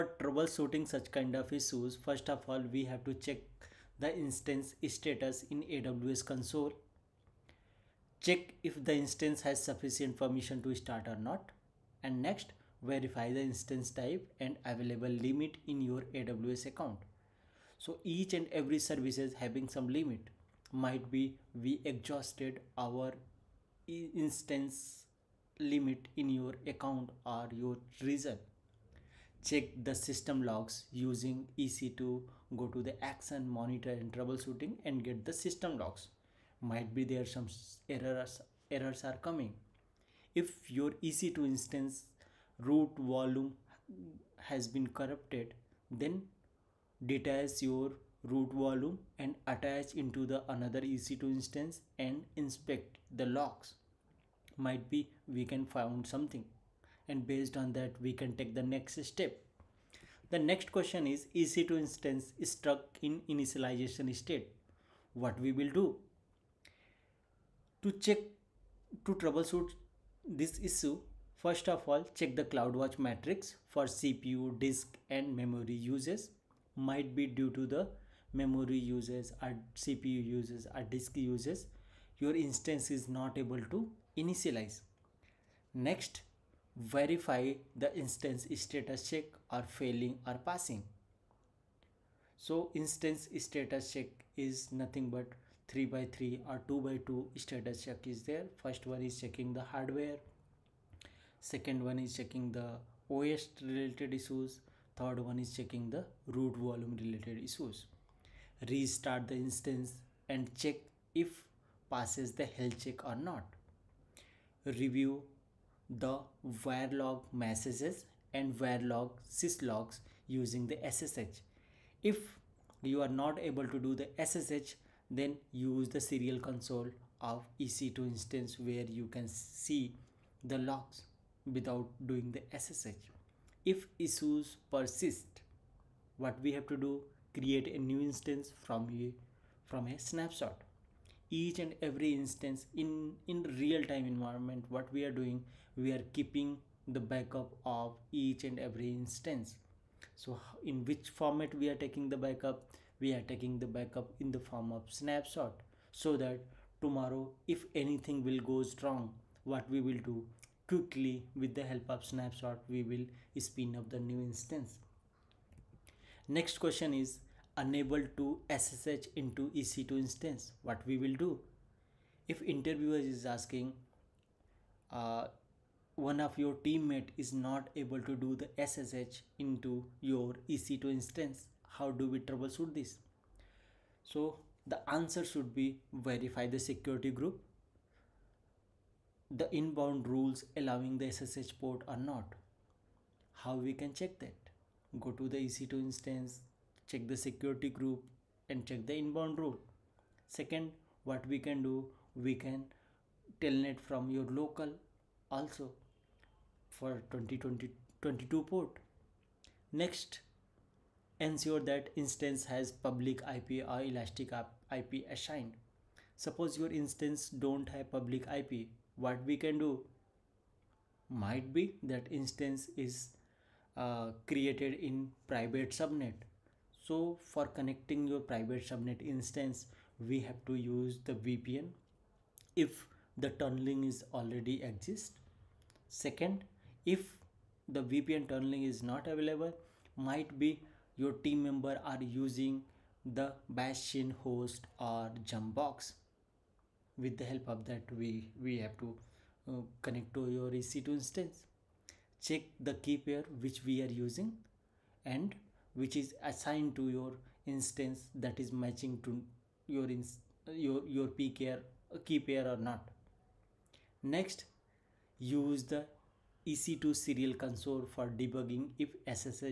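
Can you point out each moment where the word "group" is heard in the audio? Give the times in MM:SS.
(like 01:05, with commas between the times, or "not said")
03:07, 03:17.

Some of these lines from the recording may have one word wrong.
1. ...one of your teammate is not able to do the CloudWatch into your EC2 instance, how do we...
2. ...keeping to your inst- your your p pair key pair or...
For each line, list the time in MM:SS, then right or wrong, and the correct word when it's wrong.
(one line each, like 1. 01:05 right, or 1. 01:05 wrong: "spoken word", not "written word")
1. 02:55 wrong: "SSH", not "CloudWatch"
2. 04:18 wrong: "matching", not "keeping".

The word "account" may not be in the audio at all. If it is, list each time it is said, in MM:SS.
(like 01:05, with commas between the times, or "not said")
00:16, 00:26.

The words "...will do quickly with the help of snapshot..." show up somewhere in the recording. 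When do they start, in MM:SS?
02:39.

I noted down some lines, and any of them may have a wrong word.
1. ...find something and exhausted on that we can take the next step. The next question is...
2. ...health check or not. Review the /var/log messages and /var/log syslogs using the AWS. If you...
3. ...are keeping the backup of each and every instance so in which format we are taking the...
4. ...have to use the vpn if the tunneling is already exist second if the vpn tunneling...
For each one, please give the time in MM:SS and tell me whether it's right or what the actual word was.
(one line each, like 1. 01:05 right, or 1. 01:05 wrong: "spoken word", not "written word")
1. 00:55 wrong: "based", not "exhausted"
2. 01:52 wrong: "SSH", not "AWS"
3. 02:25 right
4. 03:50 right.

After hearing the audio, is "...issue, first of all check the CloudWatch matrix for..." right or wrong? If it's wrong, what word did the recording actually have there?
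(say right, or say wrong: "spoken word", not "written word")
right.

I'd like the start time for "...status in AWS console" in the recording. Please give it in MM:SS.
00:04.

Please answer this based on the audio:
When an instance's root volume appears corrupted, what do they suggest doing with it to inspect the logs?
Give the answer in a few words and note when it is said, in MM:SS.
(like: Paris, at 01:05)
Attach it to another EC2 instance, at 00:49.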